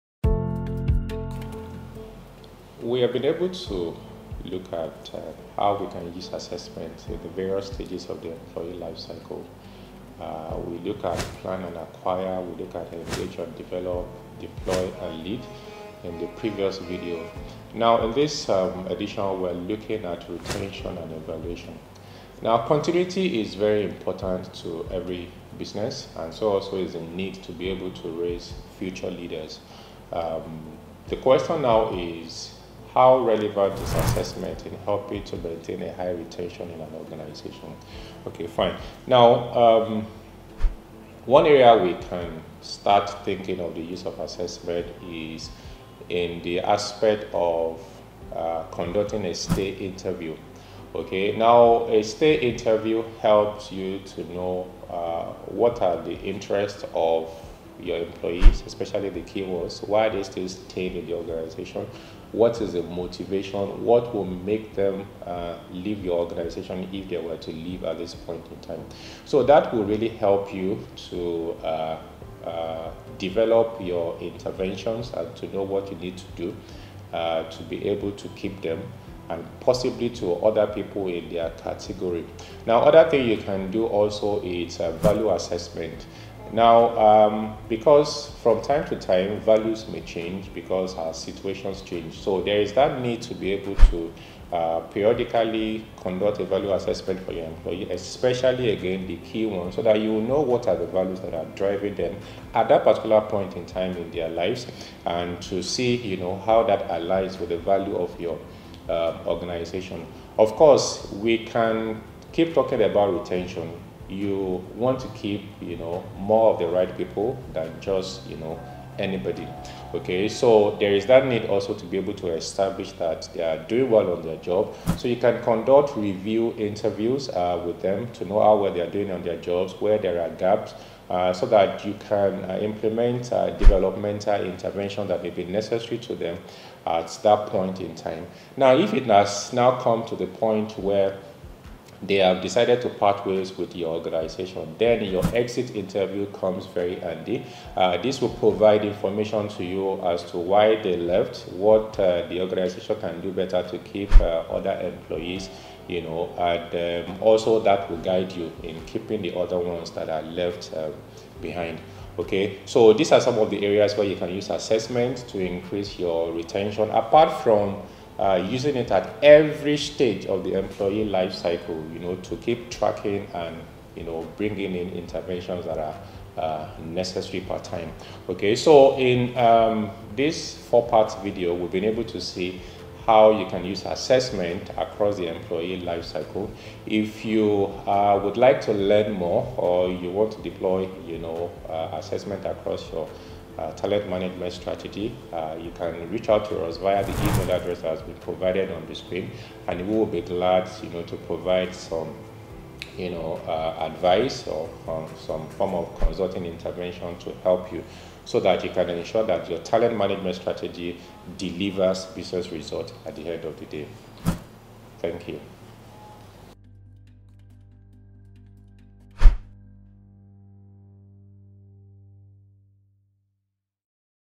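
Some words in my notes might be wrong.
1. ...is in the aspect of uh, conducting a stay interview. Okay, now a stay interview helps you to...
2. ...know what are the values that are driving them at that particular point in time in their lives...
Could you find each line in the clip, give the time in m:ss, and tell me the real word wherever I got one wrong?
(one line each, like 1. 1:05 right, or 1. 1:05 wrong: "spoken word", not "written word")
1. 0:45 right
2. 1:40 right.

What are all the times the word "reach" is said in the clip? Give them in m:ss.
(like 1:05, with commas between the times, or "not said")
3:16.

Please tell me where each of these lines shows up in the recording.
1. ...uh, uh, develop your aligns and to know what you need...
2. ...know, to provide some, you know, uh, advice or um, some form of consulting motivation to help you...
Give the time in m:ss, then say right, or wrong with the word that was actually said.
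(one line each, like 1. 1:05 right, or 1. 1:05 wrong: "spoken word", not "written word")
1. 1:11 wrong: "interventions", not "aligns"
2. 3:20 wrong: "intervention", not "motivation".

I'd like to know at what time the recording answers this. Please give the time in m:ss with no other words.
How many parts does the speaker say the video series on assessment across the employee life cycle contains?
3:00.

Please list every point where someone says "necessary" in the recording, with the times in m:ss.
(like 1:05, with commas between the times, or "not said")
2:15, 2:56.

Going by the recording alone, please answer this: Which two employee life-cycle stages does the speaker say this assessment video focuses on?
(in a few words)
Retention and evaluation.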